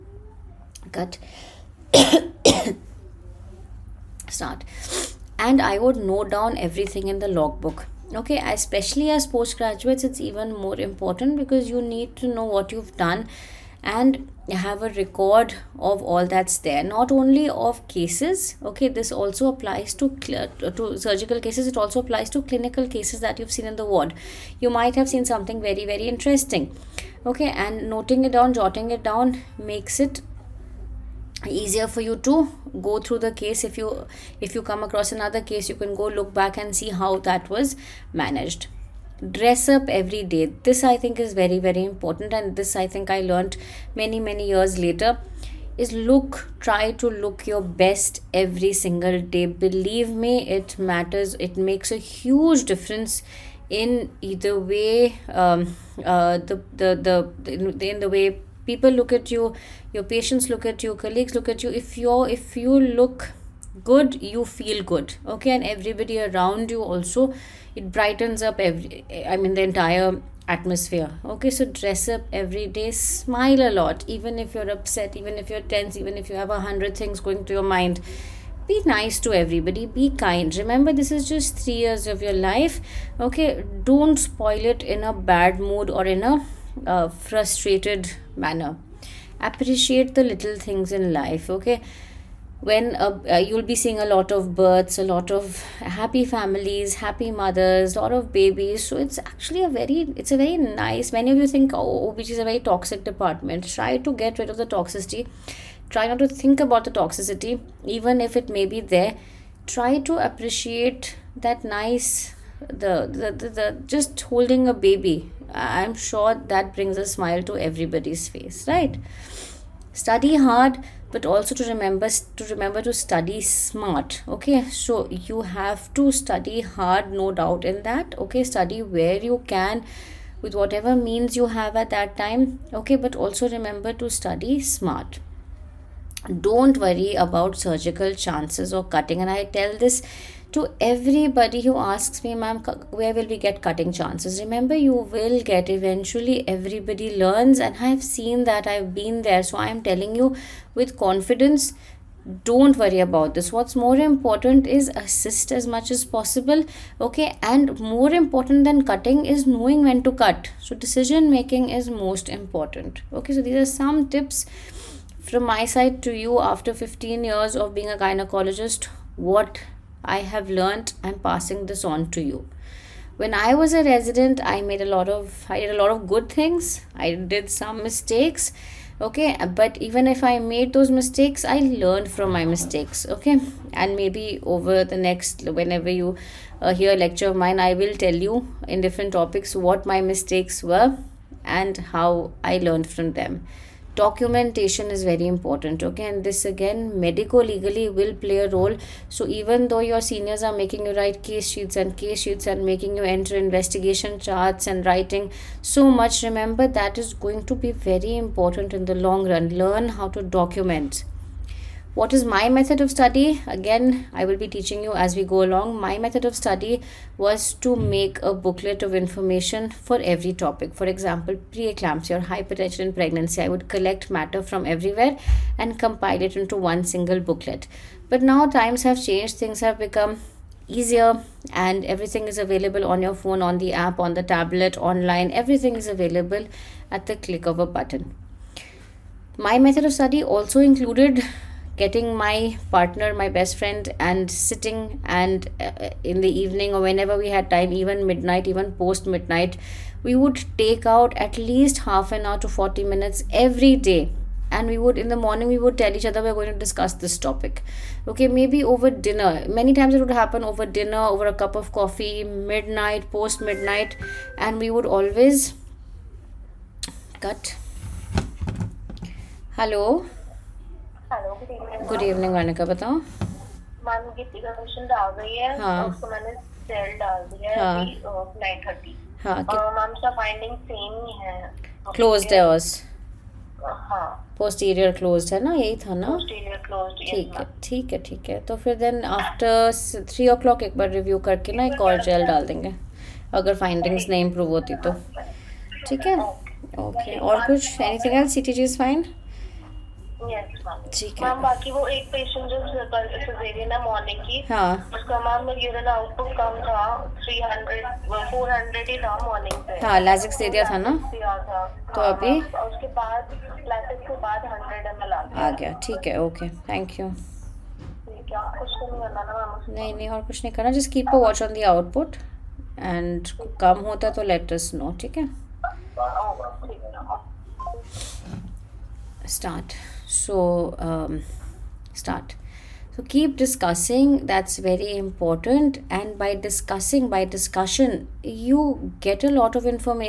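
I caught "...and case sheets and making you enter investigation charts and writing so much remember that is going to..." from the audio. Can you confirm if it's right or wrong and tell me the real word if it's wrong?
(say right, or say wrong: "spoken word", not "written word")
right.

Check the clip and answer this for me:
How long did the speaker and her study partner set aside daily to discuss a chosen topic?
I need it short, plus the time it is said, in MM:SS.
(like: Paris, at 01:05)
Half an hour to 40 minutes, at 04:11.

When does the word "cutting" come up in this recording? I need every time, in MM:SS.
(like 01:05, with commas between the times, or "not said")
02:18, 02:23, 02:38.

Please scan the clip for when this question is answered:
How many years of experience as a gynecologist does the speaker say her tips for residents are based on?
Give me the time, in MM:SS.
02:46.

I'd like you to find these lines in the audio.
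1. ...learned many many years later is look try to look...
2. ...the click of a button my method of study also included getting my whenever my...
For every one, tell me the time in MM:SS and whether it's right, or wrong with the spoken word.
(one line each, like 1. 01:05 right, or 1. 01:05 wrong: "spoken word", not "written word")
1. 00:43 right
2. 03:57 wrong: "partner", not "whenever".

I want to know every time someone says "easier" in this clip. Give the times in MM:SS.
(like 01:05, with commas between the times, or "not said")
00:31, 03:50.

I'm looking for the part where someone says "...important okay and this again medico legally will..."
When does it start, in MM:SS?
03:15.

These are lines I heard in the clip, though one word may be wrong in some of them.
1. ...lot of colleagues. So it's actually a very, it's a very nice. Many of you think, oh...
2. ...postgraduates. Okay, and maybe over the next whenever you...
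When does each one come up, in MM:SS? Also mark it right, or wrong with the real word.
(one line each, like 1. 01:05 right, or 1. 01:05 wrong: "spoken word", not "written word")
1. 01:38 wrong: "babies", not "colleagues"
2. 03:02 wrong: "mistakes", not "postgraduates".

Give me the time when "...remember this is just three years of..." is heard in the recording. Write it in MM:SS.
01:20.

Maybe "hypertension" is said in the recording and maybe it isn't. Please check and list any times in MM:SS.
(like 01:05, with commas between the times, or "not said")
03:42.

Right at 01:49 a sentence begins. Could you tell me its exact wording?
Try to appreciate that nice, the the, the, the just holding a baby.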